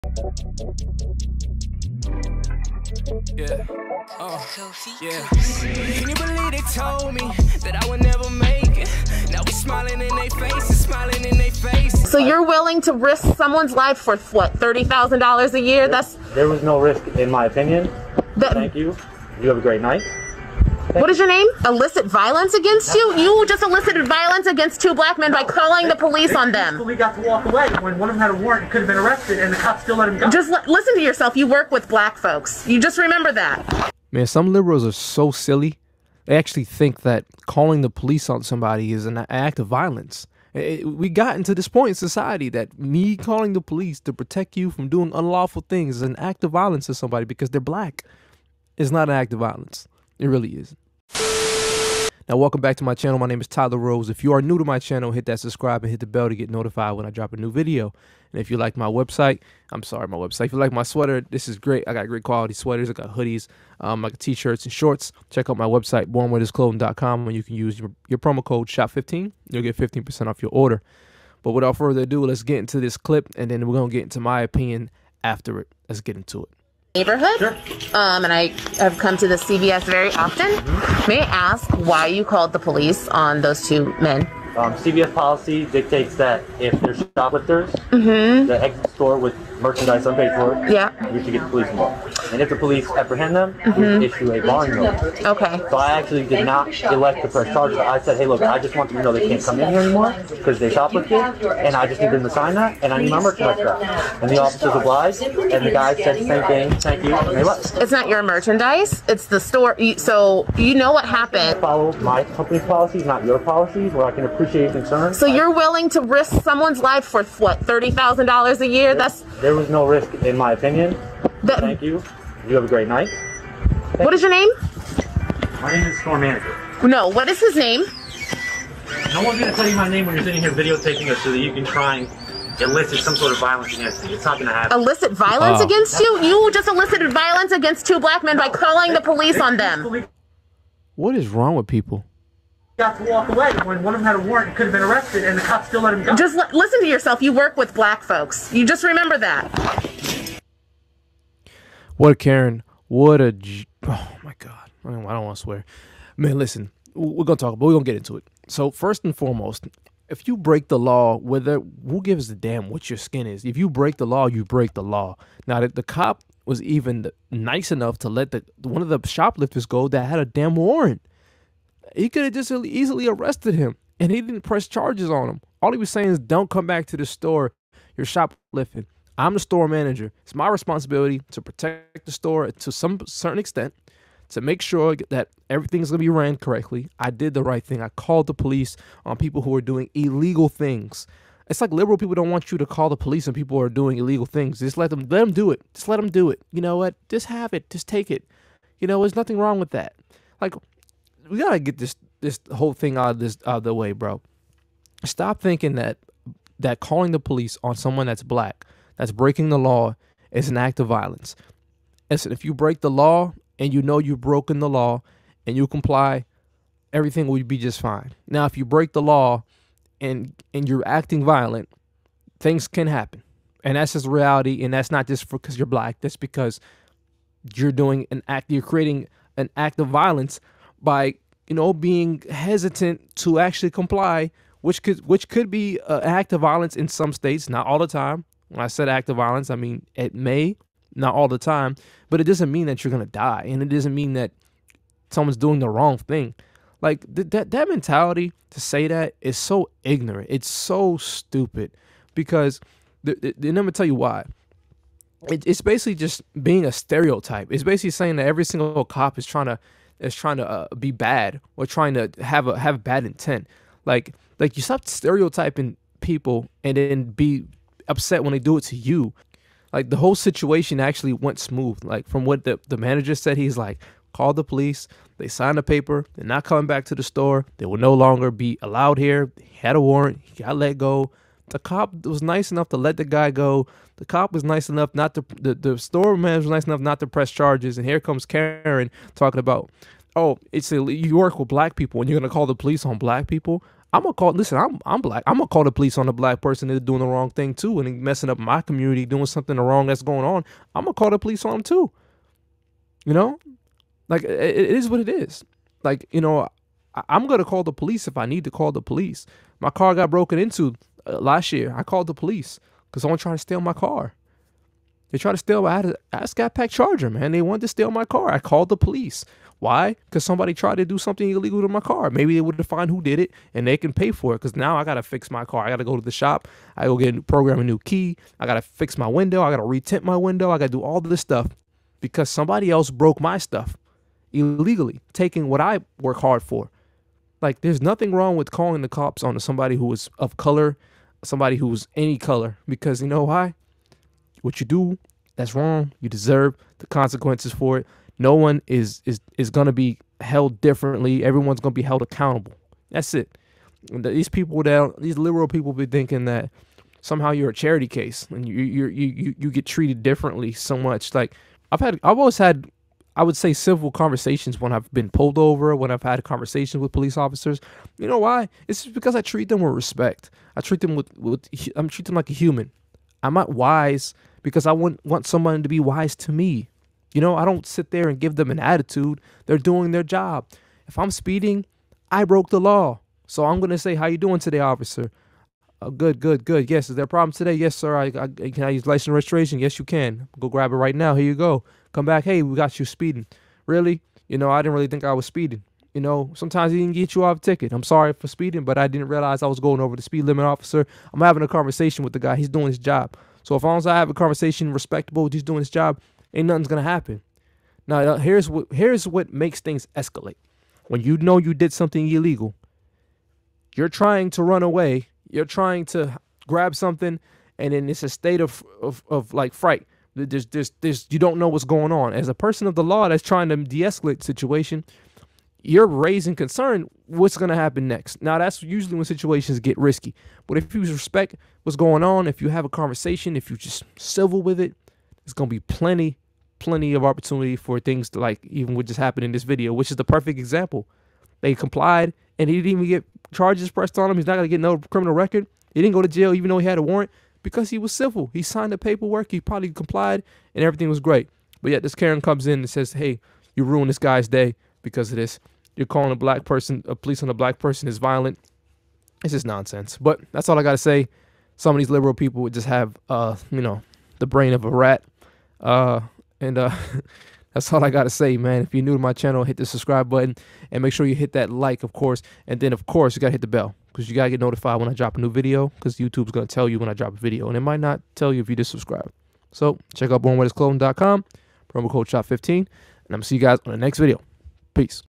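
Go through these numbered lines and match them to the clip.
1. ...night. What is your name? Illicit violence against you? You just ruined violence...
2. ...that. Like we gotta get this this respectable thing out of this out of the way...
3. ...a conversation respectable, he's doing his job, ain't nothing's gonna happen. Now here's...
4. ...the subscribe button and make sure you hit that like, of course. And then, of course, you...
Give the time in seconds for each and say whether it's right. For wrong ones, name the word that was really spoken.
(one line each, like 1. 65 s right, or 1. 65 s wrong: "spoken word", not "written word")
1. 19 s wrong: "elicited", not "ruined"
2. 199 s wrong: "whole", not "respectable"
3. 404 s right
4. 469 s right.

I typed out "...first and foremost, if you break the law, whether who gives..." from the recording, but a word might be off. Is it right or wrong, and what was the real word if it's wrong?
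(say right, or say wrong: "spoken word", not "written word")
right.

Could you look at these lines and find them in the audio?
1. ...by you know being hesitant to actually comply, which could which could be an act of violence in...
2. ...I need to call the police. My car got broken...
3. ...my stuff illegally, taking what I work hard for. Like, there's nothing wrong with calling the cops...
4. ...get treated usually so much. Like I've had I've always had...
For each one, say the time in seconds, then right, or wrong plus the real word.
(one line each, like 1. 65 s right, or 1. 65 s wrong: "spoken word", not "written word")
1. 230 s right
2. 308 s right
3. 333 s right
4. 359 s wrong: "differently", not "usually".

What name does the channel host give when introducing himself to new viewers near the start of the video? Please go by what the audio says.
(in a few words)
Tyler Rose.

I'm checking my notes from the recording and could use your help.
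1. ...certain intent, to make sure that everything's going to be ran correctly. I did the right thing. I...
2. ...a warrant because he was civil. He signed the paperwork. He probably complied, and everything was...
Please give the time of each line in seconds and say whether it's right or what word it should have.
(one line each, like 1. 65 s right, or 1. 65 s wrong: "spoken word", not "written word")
1. 183 s wrong: "extent", not "intent"
2. 446 s right.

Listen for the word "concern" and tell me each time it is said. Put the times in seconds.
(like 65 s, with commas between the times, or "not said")
114 s, 426 s.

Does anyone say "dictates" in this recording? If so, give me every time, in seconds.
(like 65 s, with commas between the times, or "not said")
85 s.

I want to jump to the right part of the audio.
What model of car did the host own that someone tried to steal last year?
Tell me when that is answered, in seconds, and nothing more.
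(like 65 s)
316 s.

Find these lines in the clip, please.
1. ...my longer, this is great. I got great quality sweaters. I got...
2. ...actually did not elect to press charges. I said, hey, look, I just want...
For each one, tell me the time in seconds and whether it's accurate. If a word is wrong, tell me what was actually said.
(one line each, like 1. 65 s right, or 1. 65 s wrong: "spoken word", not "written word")
1. 60 s wrong: "sweater", not "longer"
2. 95 s right.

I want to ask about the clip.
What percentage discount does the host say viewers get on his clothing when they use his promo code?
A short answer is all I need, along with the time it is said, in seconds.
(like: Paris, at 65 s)
15%, at 69 s.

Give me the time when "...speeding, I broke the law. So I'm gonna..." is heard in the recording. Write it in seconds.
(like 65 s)
381 s.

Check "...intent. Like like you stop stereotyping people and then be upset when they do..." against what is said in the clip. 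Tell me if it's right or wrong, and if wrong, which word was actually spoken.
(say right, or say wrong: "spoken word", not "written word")
right.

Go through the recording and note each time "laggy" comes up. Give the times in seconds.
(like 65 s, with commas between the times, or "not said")
not said.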